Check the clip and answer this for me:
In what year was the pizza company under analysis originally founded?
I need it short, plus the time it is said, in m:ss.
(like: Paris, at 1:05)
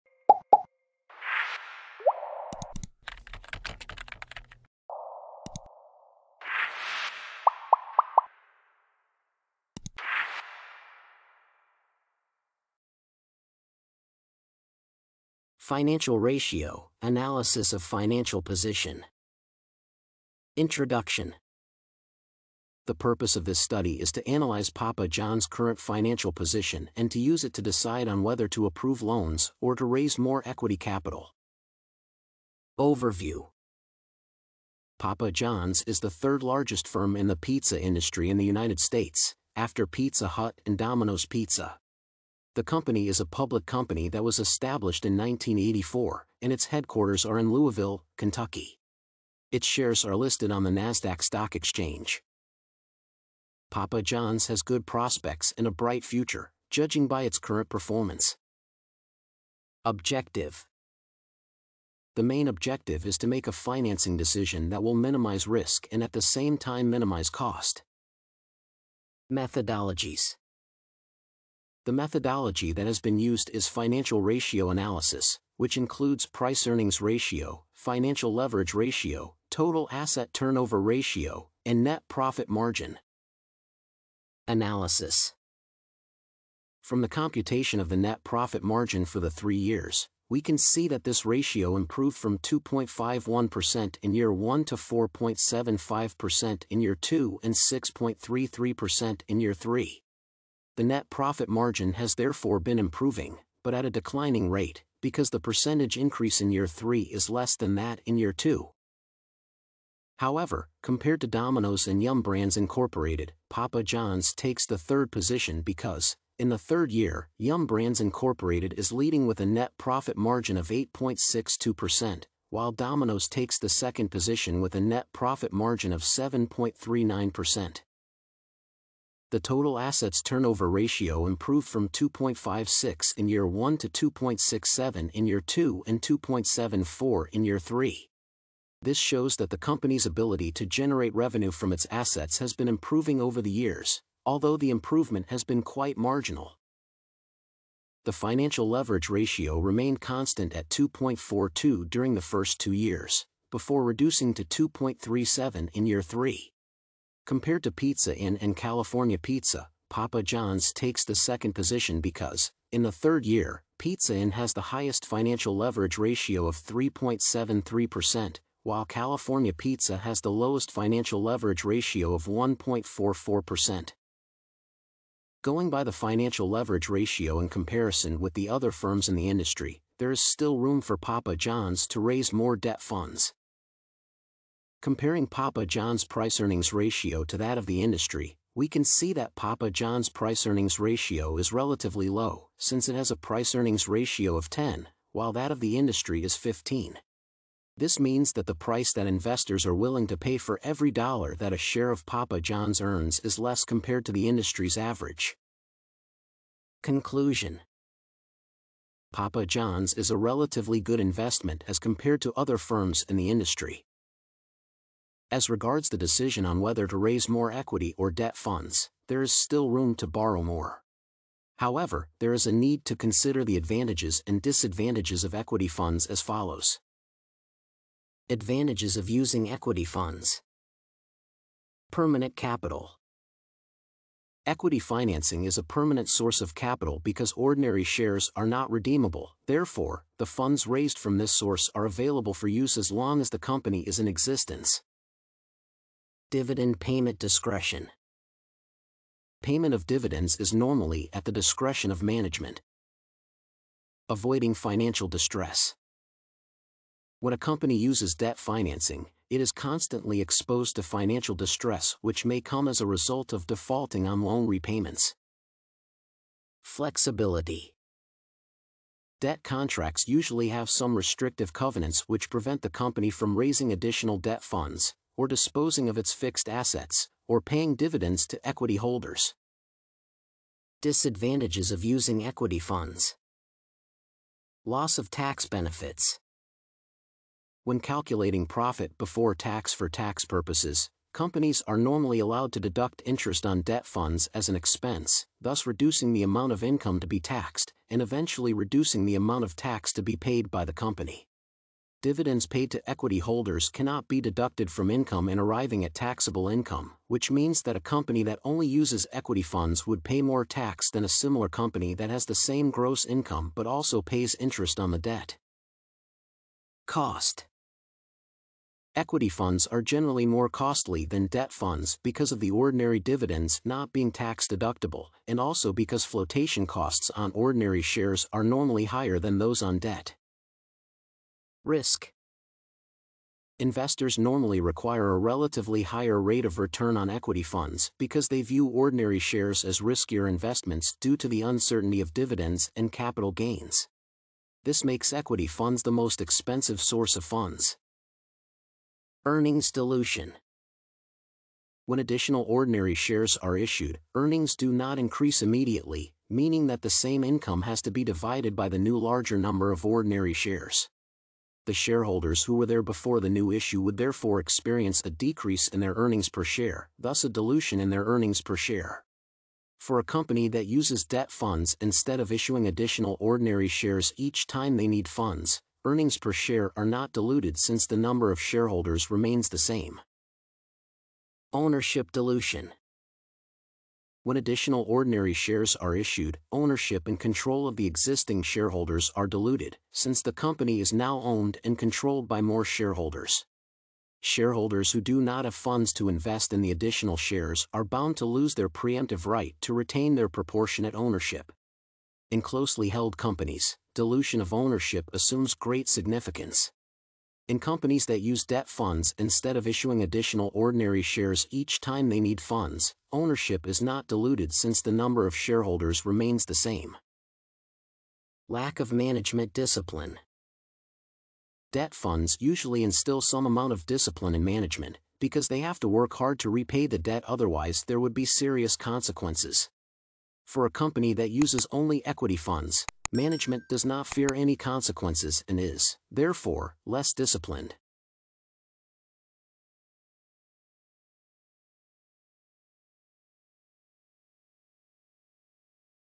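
1984, at 0:45.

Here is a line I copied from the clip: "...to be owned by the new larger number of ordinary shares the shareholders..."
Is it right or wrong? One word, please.
wrong.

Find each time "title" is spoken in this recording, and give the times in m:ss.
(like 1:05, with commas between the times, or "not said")
not said.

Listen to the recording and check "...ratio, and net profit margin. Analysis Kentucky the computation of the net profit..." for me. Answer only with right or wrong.
wrong.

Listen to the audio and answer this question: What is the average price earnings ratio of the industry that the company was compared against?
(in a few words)
15.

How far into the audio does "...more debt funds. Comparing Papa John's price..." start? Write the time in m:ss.
3:02.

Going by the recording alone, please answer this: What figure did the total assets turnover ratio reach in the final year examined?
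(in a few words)
2.74.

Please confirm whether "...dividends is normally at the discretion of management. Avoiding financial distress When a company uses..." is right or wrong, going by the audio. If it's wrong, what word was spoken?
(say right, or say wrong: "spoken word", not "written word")
right.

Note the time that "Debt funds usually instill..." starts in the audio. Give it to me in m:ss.
7:01.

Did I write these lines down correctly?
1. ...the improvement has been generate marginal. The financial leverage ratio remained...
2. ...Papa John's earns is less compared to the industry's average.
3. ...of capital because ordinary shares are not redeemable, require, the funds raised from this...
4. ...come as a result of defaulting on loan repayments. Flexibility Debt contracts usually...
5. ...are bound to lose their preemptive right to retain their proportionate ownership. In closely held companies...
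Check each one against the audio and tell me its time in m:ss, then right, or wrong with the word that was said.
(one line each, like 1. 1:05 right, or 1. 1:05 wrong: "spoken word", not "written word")
1. 2:24 wrong: "quite", not "generate"
2. 3:22 right
3. 3:56 wrong: "therefore", not "require"
4. 4:22 right
5. 6:37 right.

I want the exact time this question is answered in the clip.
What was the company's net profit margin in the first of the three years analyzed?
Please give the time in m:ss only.
1:32.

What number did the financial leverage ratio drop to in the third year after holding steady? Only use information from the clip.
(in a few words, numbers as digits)
2.37.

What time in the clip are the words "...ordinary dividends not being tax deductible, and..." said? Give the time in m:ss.
5:22.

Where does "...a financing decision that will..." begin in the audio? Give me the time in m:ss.
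1:03.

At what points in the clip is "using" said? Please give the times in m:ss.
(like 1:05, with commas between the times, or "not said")
3:49, 4:41.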